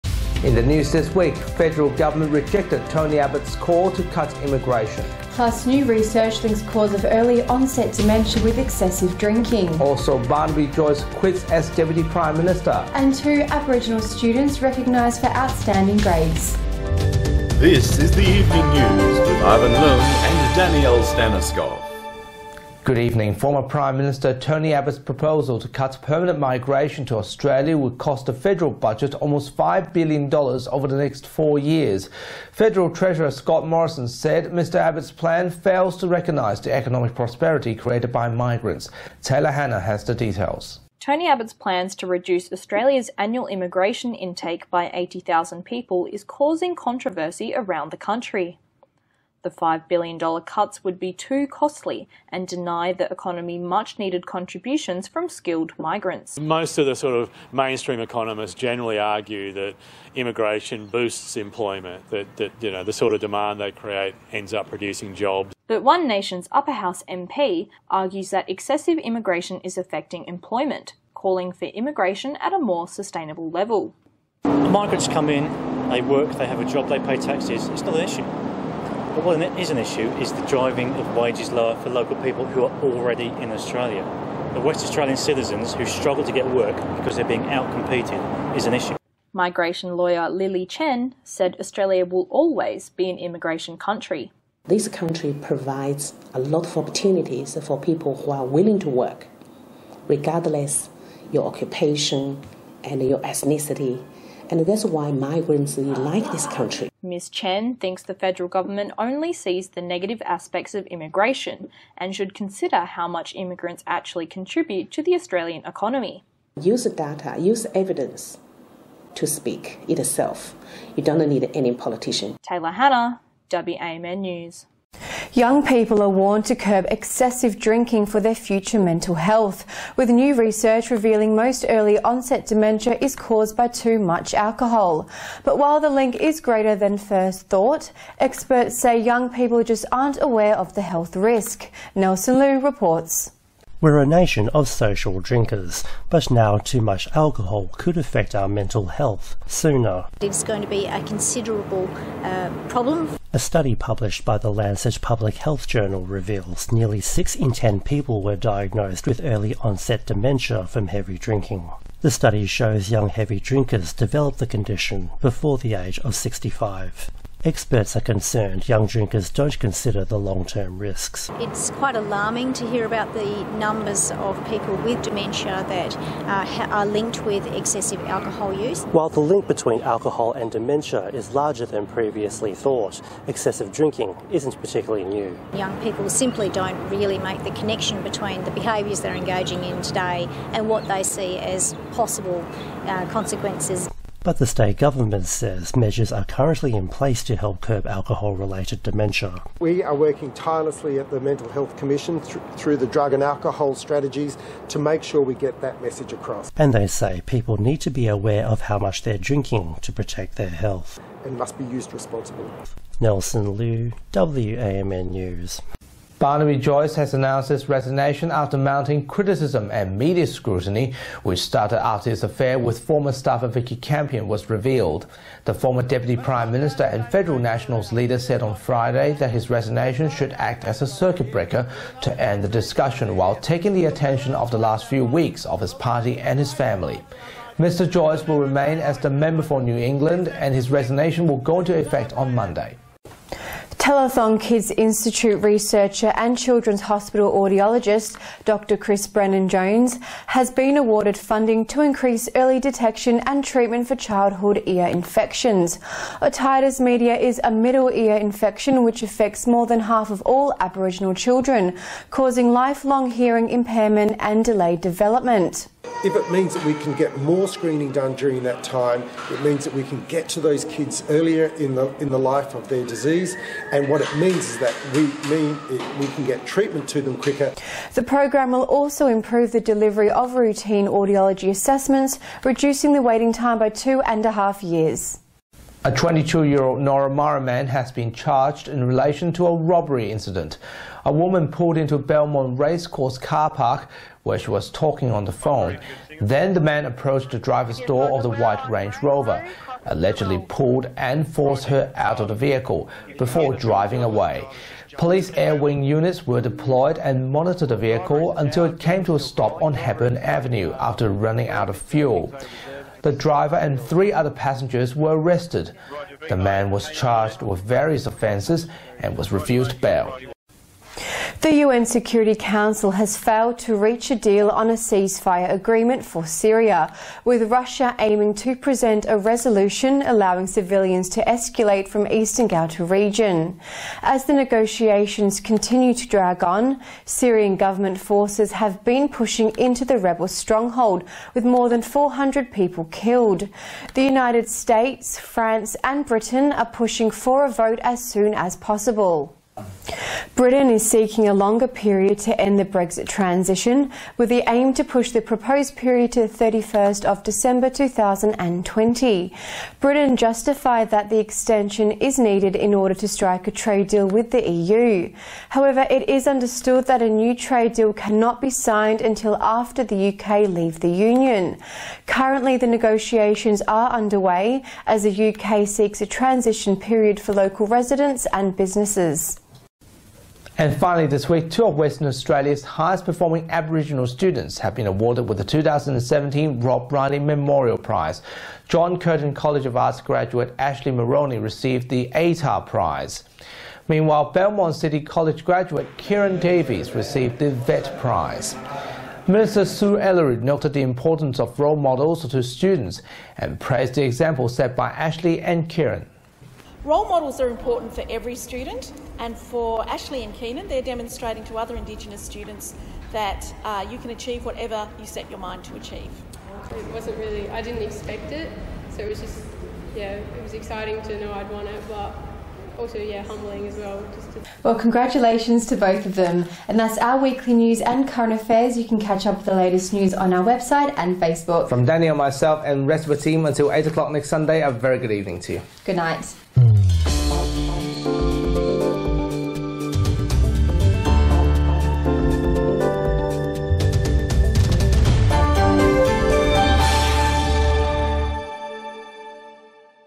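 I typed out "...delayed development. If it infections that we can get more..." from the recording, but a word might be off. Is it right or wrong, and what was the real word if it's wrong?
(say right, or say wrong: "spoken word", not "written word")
wrong: "means", not "infections".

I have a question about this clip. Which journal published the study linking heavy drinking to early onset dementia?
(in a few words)
Lancet Public Health Journal.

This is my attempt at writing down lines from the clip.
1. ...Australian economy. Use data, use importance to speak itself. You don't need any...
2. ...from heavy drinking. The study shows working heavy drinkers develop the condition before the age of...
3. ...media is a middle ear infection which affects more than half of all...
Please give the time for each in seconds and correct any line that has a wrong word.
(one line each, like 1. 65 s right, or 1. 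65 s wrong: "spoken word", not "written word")
1. 115 s wrong: "evidence", not "importance"
2. 160 s wrong: "young", not "working"
3. 256 s right.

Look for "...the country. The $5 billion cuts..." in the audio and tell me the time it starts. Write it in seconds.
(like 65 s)
47 s.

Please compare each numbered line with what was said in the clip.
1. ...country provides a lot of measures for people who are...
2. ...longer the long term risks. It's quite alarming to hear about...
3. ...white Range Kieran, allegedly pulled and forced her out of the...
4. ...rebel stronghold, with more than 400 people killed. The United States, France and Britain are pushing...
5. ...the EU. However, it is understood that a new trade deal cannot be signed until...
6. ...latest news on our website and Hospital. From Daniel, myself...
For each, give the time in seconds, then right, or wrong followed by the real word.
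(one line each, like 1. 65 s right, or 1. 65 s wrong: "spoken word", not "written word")
1. 94 s wrong: "opportunities", not "measures"
2. 169 s wrong: "consider", not "longer"
3. 298 s wrong: "Rover", not "Kieran"
4. 339 s right
5. 364 s right
6. 429 s wrong: "Facebook", not "Hospital".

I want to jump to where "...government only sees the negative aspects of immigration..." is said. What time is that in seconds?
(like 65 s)
108 s.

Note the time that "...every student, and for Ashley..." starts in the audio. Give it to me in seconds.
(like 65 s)
408 s.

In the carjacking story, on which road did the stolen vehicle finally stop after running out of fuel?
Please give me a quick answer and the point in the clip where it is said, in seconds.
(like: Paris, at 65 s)
Hepburn Avenue, at 309 s.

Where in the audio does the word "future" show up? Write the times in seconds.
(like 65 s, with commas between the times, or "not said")
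128 s.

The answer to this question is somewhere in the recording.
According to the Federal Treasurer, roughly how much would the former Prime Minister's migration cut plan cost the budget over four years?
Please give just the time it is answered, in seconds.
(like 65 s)
29 s.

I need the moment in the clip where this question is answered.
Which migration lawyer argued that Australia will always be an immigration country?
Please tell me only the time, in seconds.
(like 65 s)
90 s.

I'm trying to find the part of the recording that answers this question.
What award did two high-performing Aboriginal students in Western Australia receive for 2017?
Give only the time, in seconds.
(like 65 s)
386 s.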